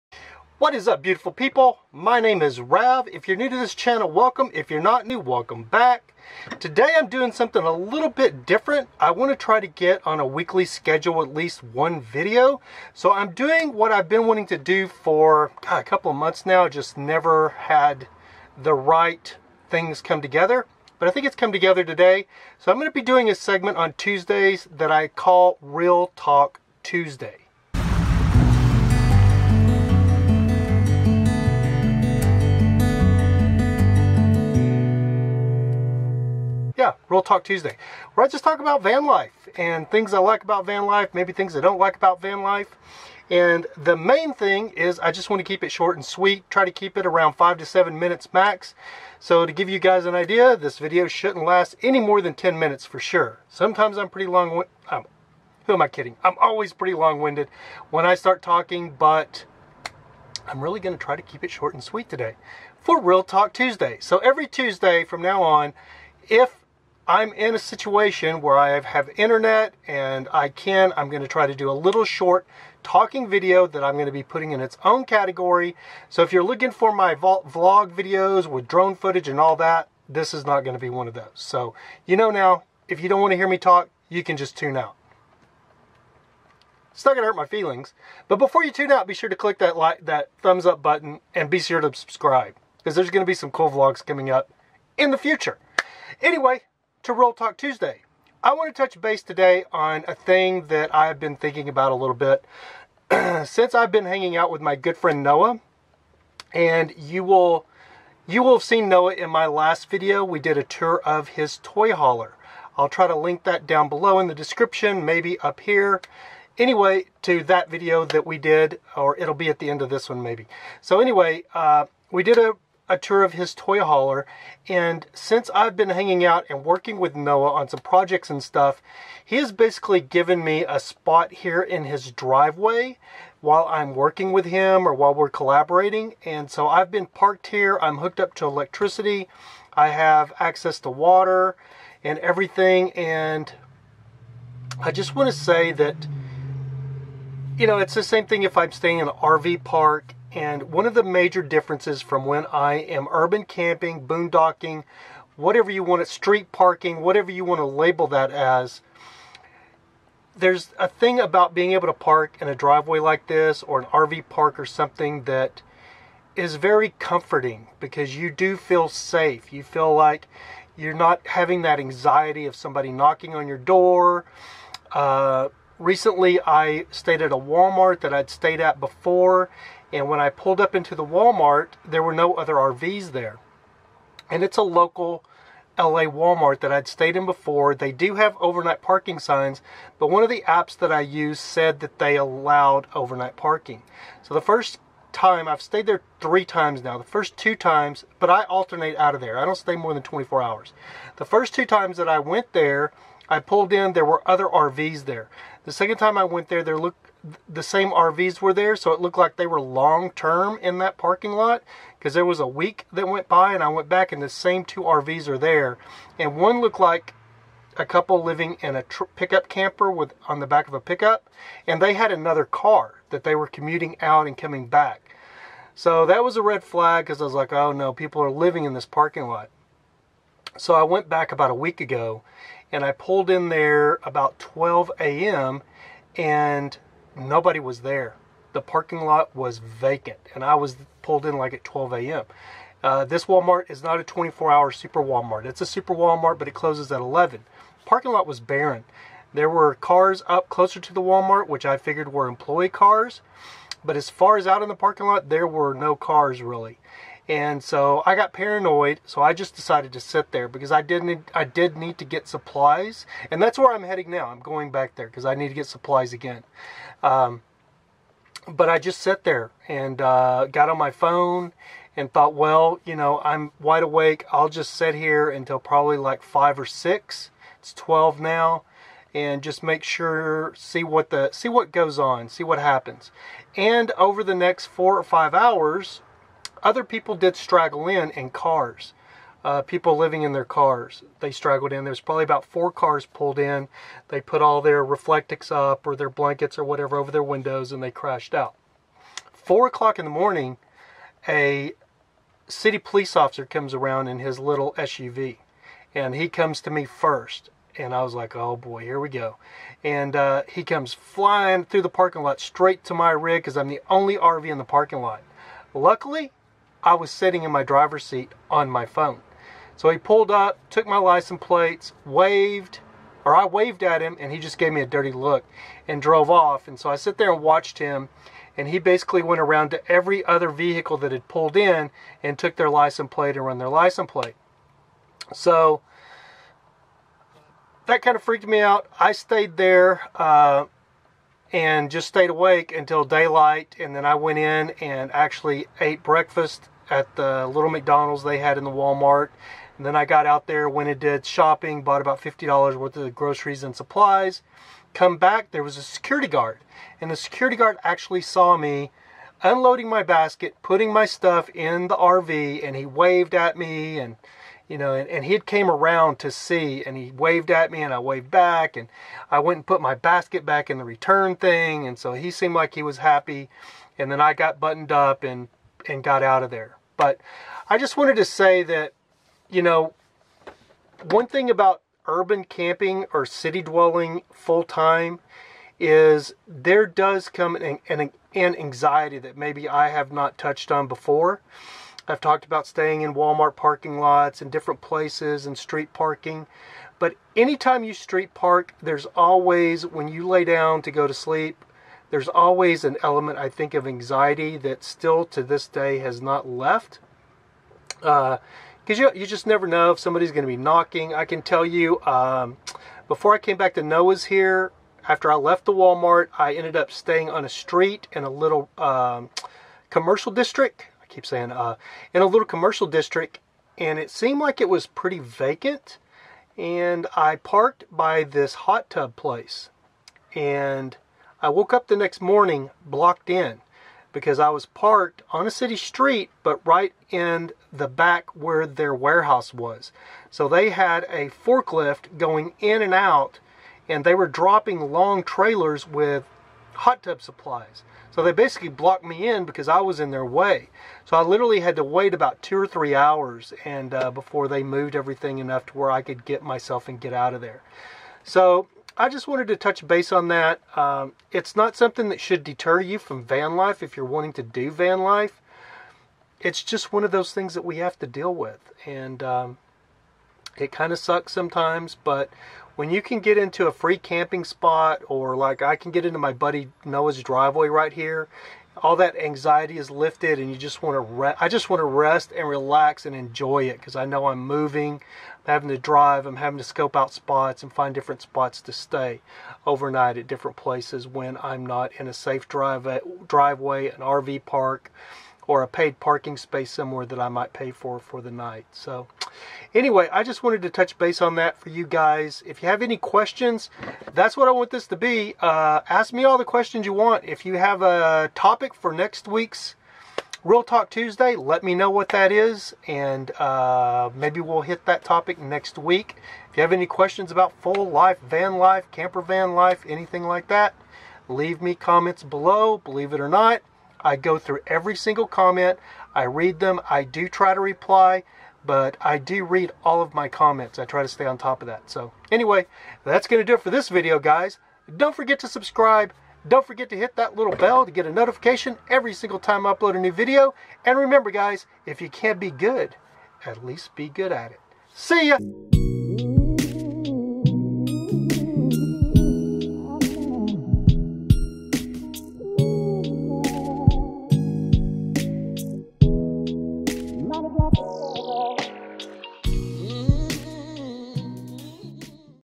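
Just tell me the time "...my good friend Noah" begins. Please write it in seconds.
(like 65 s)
104 s.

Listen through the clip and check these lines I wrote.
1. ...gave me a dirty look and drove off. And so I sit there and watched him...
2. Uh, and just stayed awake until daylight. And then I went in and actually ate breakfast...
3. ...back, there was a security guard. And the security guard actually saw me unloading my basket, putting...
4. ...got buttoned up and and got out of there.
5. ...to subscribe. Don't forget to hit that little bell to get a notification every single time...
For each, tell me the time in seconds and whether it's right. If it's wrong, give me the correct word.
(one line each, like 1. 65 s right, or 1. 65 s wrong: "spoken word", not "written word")
1. 324 s right
2. 340 s right
3. 355 s right
4. 374 s right
5. 535 s right.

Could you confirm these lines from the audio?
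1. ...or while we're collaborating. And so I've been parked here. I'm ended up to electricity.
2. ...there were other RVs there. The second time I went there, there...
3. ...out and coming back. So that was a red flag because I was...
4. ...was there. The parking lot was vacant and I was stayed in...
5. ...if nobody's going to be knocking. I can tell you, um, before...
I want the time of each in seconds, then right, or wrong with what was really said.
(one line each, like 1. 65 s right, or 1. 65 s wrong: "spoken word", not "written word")
1. 134 s wrong: "hooked", not "ended"
2. 203 s right
3. 224 s right
4. 237 s wrong: "pulled", not "stayed"
5. 409 s wrong: "somebody", not "nobody".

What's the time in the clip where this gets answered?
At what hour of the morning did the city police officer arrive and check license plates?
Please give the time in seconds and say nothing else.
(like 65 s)
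299 s.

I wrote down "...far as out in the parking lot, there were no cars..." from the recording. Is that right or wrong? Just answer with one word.
right.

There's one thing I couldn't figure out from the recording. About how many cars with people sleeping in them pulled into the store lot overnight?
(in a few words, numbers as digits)
4.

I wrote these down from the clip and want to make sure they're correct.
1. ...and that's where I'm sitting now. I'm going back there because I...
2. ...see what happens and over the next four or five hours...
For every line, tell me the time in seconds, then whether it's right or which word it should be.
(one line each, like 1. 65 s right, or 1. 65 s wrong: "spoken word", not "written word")
1. 263 s wrong: "heading", not "sitting"
2. 282 s right.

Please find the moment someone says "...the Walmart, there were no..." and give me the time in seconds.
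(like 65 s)
180 s.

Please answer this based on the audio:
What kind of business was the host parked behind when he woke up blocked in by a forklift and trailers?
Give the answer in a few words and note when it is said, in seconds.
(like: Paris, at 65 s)
Hot tub place, at 428 s.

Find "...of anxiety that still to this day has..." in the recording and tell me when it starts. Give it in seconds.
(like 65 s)
403 s.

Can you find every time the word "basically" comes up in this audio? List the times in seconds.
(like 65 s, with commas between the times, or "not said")
129 s, 328 s, 448 s.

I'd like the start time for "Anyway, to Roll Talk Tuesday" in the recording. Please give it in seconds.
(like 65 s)
96 s.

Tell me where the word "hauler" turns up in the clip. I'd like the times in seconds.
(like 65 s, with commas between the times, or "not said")
111 s, 123 s.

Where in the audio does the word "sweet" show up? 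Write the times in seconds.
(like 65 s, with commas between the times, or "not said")
46 s, 61 s.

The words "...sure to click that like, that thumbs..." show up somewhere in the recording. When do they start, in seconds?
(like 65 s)
89 s.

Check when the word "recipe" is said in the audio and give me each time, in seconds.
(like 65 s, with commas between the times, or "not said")
not said.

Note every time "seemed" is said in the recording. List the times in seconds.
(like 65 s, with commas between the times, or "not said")
372 s, 424 s.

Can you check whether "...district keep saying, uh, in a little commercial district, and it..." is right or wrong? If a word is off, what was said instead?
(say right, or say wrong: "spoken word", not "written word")
right.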